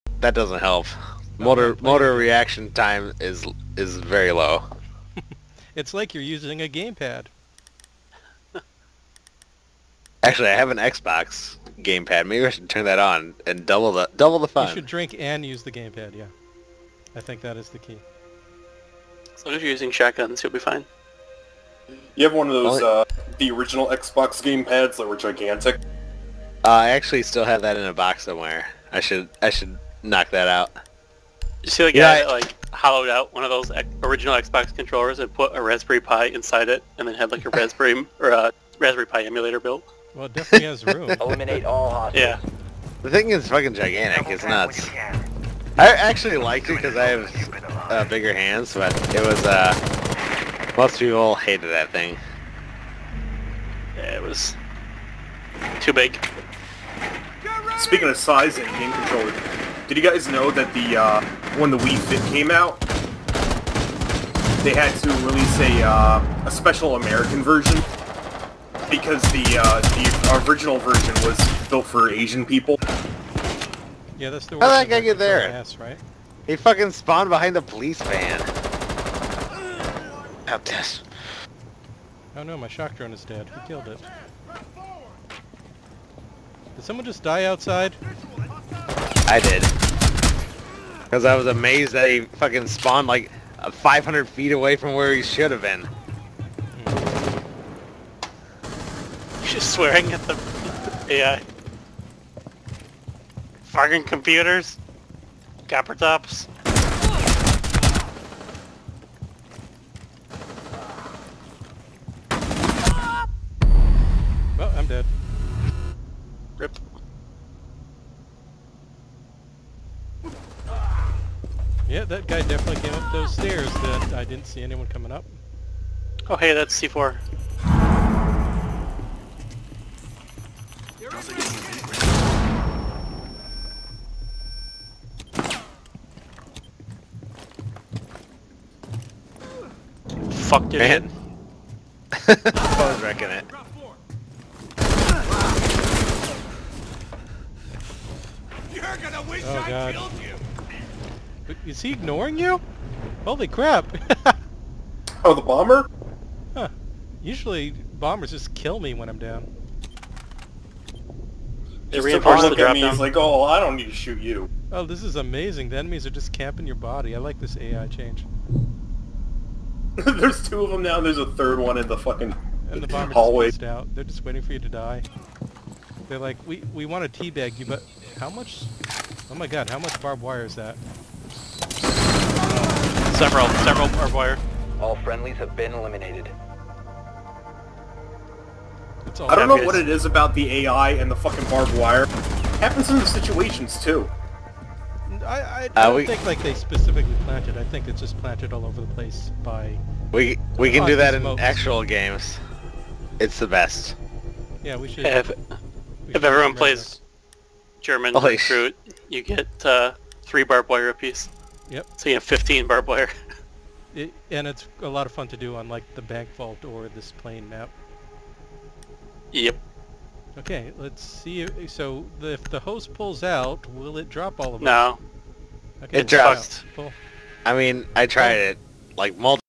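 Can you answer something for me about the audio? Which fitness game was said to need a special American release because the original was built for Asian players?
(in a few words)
Wii Fit.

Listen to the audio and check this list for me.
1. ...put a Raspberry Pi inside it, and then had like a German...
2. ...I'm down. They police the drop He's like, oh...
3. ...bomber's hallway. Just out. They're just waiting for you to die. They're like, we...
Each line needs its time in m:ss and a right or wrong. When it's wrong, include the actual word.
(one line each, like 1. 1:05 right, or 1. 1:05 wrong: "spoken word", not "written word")
1. 0:35 wrong: "Raspberry", not "German"
2. 2:39 wrong: "reinforce", not "police"
3. 2:52 right.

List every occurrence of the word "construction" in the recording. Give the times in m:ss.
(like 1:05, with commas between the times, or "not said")
not said.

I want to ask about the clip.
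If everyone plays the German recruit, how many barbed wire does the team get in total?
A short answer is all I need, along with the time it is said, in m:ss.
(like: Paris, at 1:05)
15, at 3:32.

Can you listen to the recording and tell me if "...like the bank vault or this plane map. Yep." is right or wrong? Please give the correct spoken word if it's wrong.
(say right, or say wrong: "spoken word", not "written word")
right.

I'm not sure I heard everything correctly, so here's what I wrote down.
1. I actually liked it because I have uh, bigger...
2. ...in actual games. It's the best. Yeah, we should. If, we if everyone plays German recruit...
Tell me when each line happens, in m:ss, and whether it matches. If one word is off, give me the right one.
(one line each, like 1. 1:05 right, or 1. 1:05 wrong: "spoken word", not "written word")
1. 0:45 right
2. 3:21 right.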